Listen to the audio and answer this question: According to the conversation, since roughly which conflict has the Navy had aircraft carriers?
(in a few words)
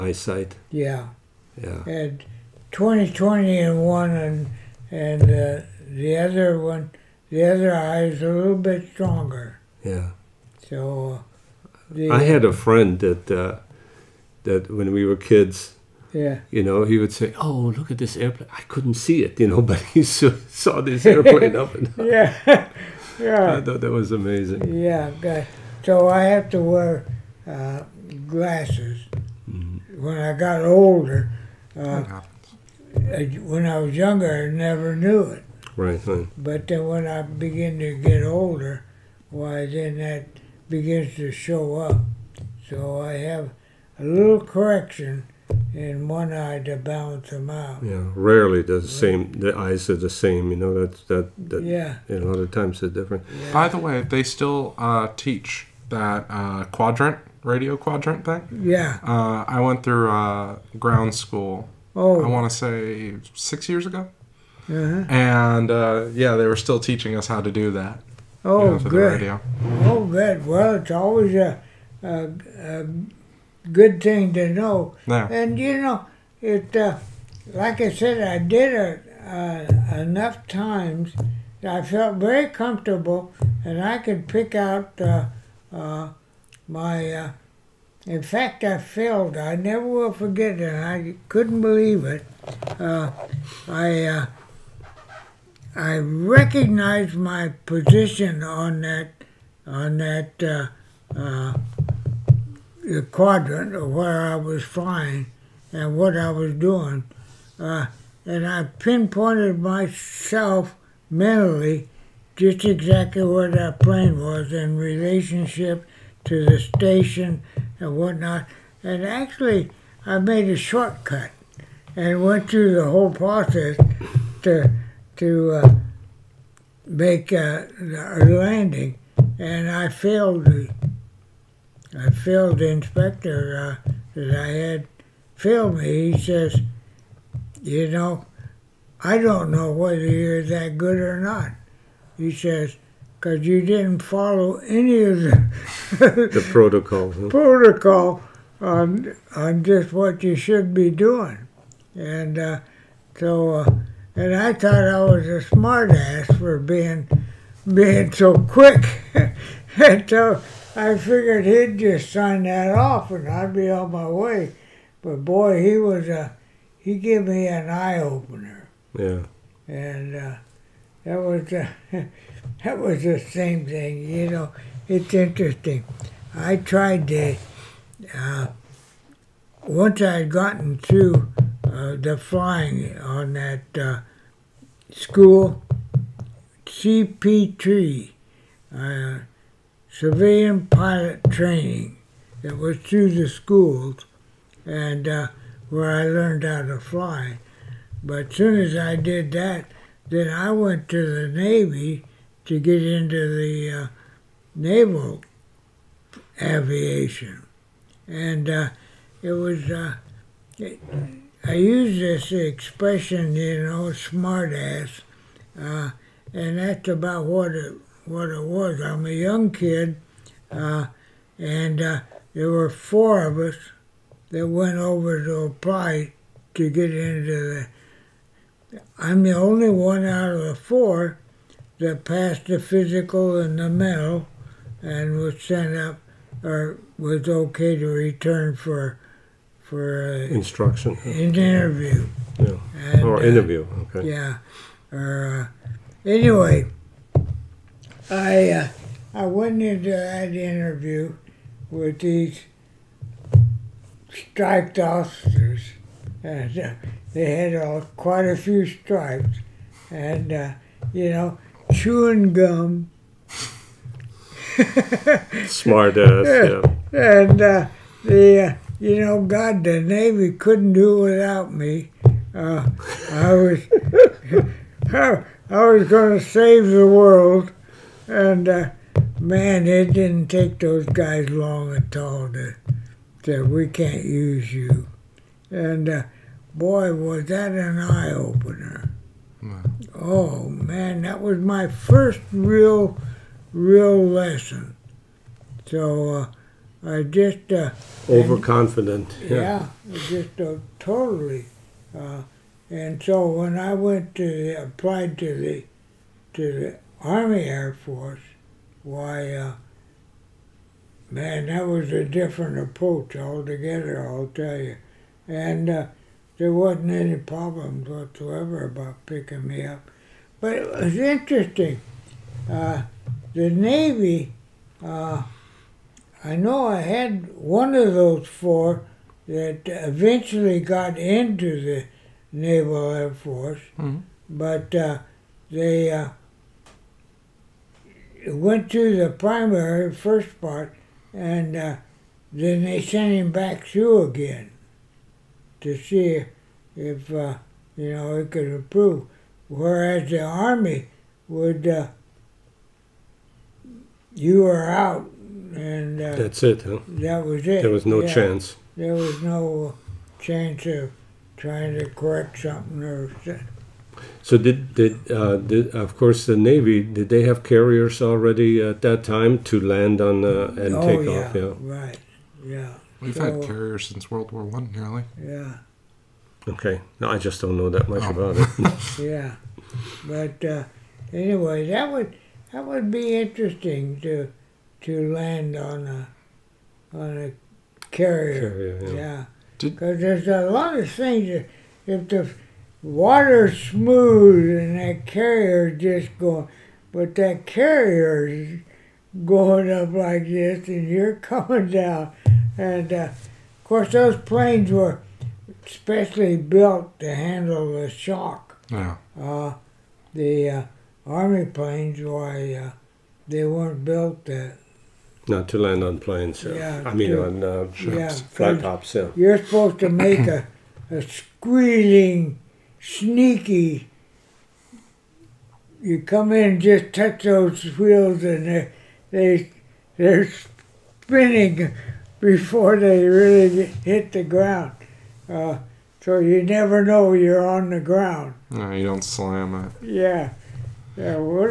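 World War One.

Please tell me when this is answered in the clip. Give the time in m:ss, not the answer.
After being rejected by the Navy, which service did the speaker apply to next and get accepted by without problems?
5:07.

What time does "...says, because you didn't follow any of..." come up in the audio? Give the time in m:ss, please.
2:22.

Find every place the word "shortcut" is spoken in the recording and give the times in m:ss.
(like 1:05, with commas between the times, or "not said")
2:00.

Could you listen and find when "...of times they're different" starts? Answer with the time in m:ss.
0:52.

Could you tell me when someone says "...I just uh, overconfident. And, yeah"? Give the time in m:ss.
4:56.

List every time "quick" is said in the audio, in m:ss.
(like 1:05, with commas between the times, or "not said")
2:38.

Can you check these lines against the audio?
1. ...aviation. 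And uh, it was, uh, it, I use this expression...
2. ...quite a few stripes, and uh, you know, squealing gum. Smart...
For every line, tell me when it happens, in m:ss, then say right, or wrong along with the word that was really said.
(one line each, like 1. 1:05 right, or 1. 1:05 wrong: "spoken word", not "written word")
1. 3:26 right
2. 4:17 wrong: "chewing", not "squealing".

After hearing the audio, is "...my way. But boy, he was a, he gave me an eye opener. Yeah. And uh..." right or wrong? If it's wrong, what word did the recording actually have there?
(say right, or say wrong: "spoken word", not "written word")
right.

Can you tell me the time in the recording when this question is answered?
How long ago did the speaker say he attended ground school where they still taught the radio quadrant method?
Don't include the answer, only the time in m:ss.
1:03.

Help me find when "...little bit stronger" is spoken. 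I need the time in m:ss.
0:08.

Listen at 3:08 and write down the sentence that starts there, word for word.
Uh, civilian pilot training that was through the schools and uh, where I learned how to fly.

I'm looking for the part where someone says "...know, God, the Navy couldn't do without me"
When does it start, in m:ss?
4:29.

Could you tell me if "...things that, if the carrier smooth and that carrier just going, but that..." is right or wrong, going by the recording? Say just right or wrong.
wrong.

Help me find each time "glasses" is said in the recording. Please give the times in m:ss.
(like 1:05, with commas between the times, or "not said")
0:28.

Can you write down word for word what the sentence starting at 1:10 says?
Well, it's always a, a, a good thing to know.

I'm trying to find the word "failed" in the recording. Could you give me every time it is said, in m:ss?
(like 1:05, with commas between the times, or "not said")
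1:28, 2:09.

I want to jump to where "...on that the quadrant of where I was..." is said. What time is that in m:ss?
1:39.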